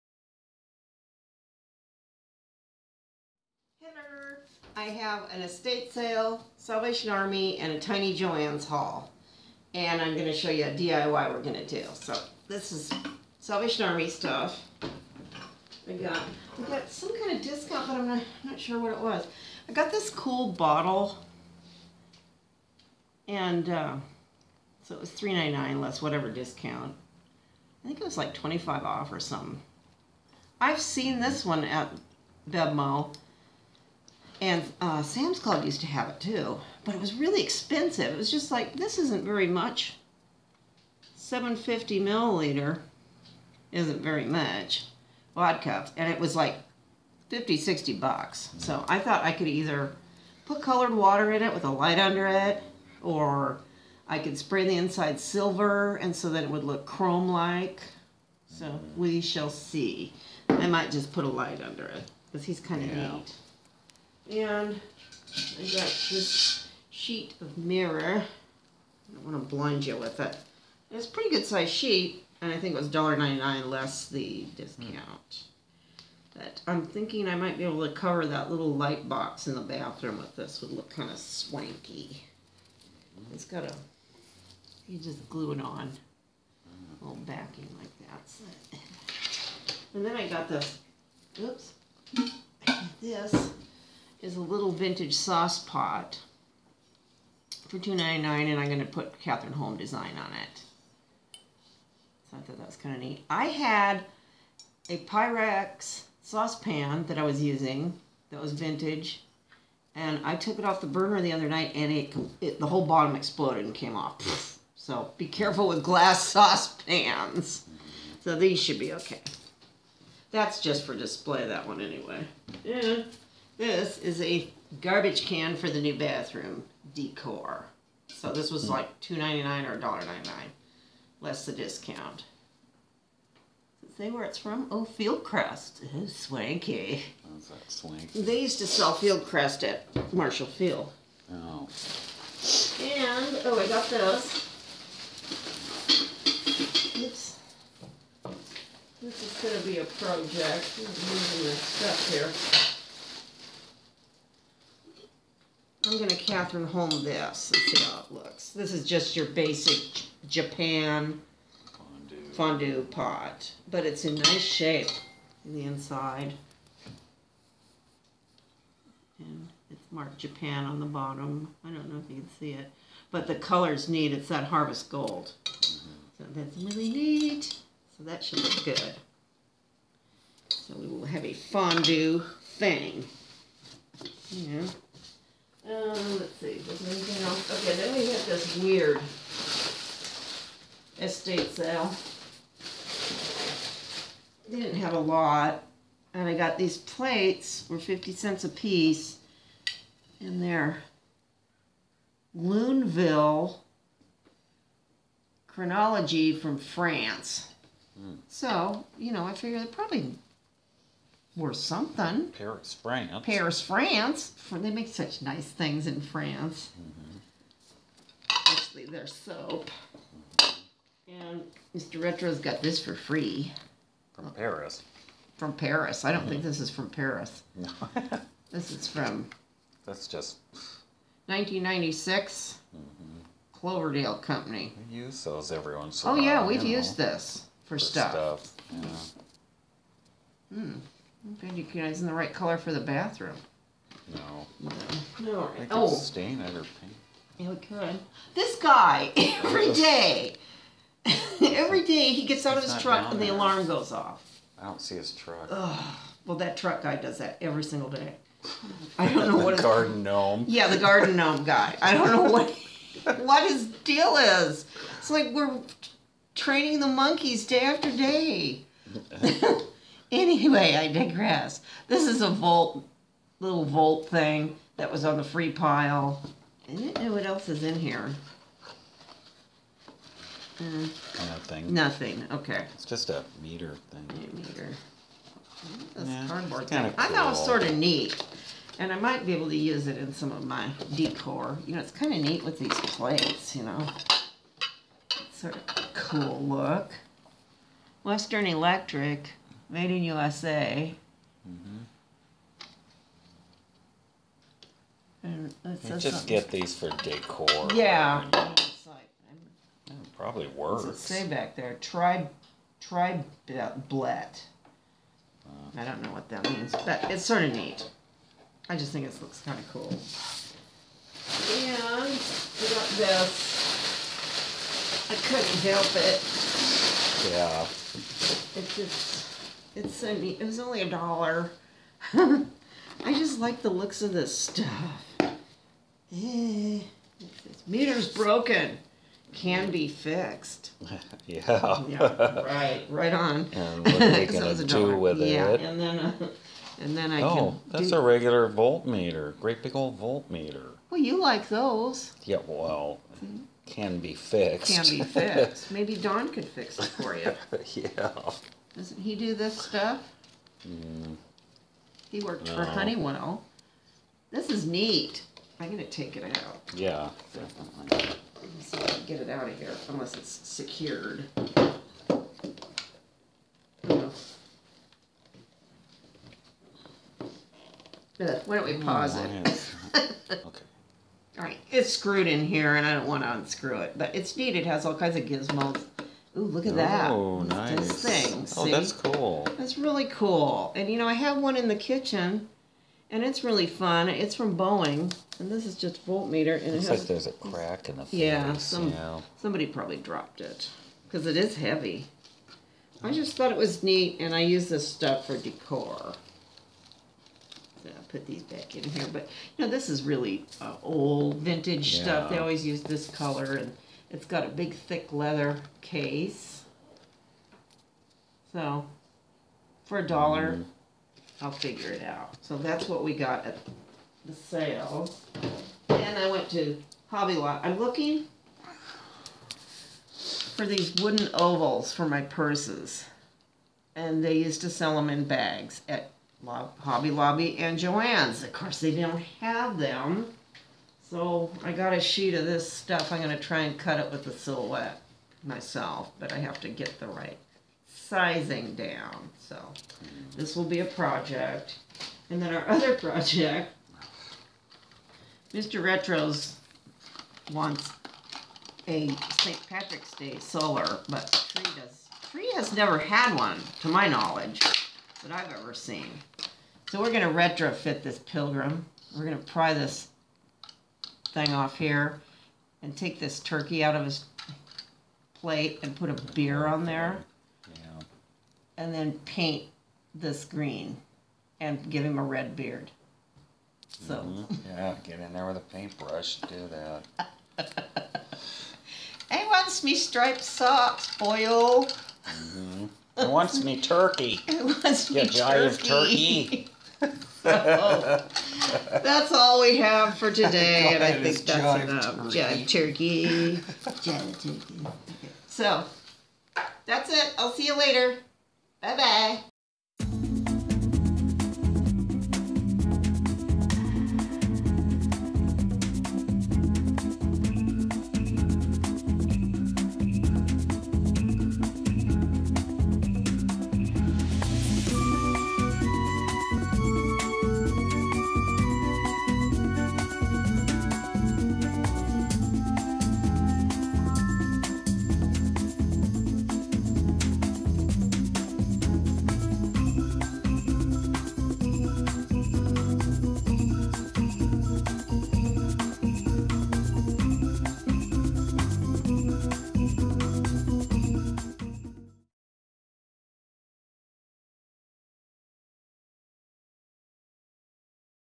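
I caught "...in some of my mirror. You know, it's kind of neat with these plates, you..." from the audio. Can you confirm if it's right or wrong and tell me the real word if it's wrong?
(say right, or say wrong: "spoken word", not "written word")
wrong: "decor", not "mirror".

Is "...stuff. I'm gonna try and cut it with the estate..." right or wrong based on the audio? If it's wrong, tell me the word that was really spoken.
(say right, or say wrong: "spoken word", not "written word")
wrong: "silhouette", not "estate".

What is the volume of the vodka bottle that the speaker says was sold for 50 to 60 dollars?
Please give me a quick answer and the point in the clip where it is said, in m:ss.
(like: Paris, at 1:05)
750 milliliters, at 0:41.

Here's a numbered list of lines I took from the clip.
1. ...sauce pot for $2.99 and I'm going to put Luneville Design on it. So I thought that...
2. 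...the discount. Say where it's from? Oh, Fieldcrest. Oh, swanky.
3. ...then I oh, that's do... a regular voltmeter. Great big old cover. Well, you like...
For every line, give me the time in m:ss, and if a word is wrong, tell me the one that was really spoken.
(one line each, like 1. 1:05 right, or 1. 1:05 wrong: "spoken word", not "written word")
1. 1:35 wrong: "Cathrineholm", not "Luneville"
2. 2:11 right
3. 5:46 wrong: "voltmeter", not "cover".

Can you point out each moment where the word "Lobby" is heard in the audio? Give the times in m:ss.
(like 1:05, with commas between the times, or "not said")
7:07, 7:17.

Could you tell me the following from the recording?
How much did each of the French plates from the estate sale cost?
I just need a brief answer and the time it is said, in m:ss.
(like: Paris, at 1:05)
50 cents, at 3:17.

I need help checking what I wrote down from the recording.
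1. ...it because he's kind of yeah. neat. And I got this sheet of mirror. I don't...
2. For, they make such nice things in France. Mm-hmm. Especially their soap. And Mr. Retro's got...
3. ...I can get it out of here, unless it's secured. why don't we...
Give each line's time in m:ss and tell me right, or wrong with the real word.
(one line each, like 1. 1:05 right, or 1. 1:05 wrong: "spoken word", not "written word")
1. 1:01 right
2. 3:34 right
3. 6:08 right.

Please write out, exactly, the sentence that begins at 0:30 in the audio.
I've seen this one at Bevmo and uh, Sam's Club used to have it too, but it was really expensive.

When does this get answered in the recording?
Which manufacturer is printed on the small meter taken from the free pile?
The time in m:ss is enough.
4:58.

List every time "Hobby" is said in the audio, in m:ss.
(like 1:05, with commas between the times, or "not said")
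7:07, 7:16.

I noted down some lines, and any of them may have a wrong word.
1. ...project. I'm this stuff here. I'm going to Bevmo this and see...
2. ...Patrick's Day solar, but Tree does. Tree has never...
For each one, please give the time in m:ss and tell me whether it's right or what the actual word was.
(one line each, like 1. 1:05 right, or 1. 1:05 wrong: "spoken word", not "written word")
1. 2:29 wrong: "Cathrineholm", not "Bevmo"
2. 7:39 right.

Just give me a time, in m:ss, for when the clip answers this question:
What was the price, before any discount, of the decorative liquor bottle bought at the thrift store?
0:25.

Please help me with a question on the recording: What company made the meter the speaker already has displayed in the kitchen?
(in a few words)
Boeing.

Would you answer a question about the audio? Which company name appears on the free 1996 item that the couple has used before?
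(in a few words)
Cloverdale Company.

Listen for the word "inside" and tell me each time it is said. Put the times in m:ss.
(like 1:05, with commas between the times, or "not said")
0:54, 2:45.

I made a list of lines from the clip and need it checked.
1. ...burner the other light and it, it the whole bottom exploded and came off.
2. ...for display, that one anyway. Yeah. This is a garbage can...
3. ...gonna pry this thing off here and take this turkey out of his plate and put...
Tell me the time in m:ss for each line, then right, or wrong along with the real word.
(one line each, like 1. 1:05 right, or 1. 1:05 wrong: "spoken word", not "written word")
1. 1:50 wrong: "night", not "light"
2. 2:00 right
3. 7:49 right.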